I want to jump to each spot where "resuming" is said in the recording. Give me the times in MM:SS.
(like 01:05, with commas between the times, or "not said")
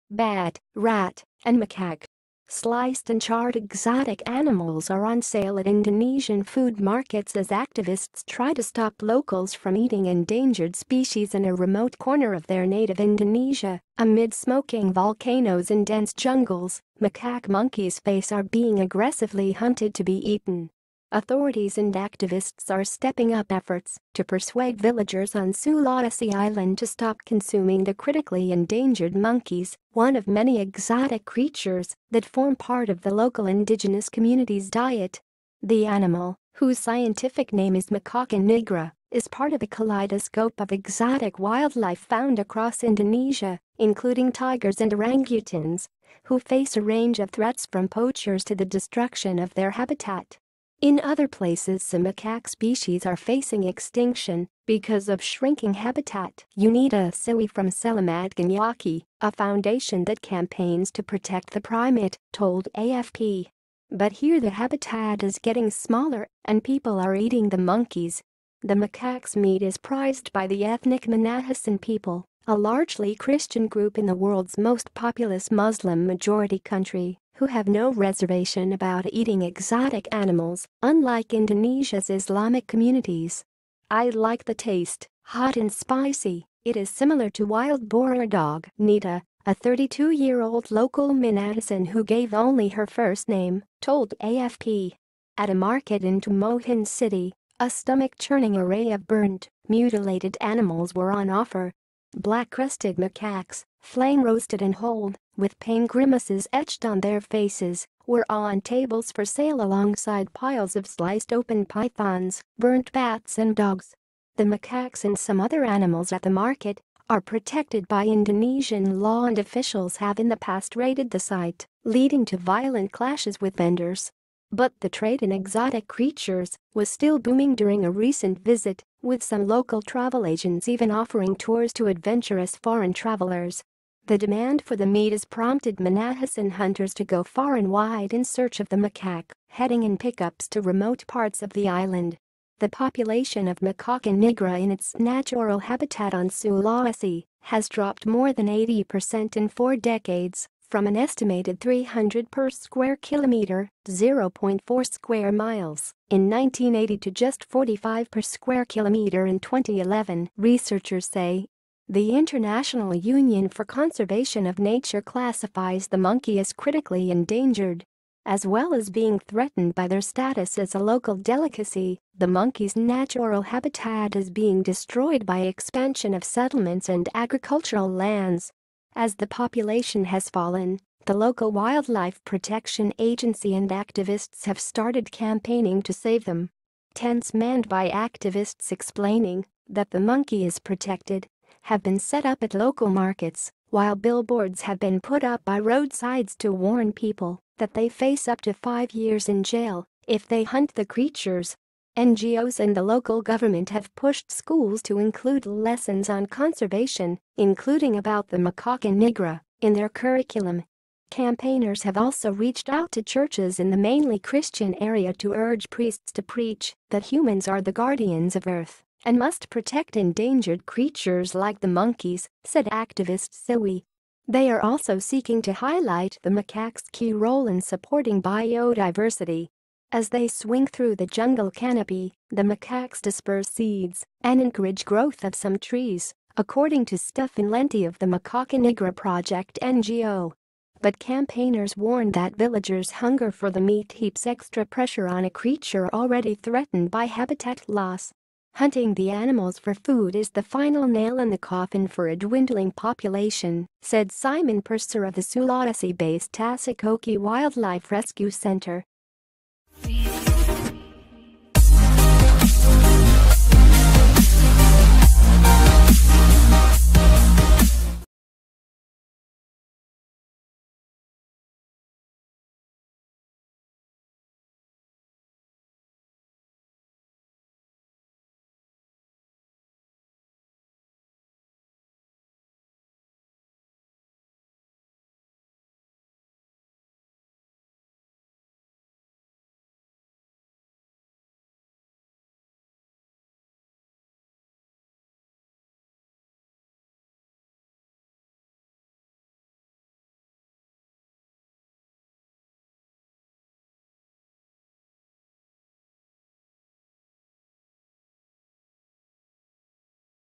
not said.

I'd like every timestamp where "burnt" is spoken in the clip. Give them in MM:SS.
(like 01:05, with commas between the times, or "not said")
01:39, 01:52.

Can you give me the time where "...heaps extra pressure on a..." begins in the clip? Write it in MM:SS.
04:03.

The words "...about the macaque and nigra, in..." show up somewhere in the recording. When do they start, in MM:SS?
03:27.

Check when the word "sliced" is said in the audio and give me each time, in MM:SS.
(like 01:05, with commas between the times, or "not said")
00:02, 01:50.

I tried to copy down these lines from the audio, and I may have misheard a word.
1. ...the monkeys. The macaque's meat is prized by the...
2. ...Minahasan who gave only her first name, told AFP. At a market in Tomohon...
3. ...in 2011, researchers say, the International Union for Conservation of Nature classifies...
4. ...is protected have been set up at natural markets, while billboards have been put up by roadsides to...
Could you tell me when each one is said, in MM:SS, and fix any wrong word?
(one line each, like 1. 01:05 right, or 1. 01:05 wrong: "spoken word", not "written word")
1. 01:07 right
2. 01:31 right
3. 02:39 right
4. 03:10 wrong: "local", not "natural".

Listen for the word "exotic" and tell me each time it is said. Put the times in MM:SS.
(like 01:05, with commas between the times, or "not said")
00:03, 00:30, 00:40, 01:19, 02:05.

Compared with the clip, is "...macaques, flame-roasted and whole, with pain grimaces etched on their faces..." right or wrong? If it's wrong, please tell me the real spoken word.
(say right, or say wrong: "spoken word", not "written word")
right.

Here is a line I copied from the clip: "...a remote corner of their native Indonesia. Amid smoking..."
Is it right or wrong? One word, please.
right.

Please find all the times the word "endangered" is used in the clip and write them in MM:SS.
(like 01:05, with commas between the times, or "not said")
00:10, 00:28, 02:47, 03:39.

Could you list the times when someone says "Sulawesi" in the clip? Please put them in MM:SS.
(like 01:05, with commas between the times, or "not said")
00:25, 02:26, 04:15.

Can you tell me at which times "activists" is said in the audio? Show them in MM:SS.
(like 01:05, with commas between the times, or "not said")
00:07, 00:21, 03:03, 03:07, 03:42.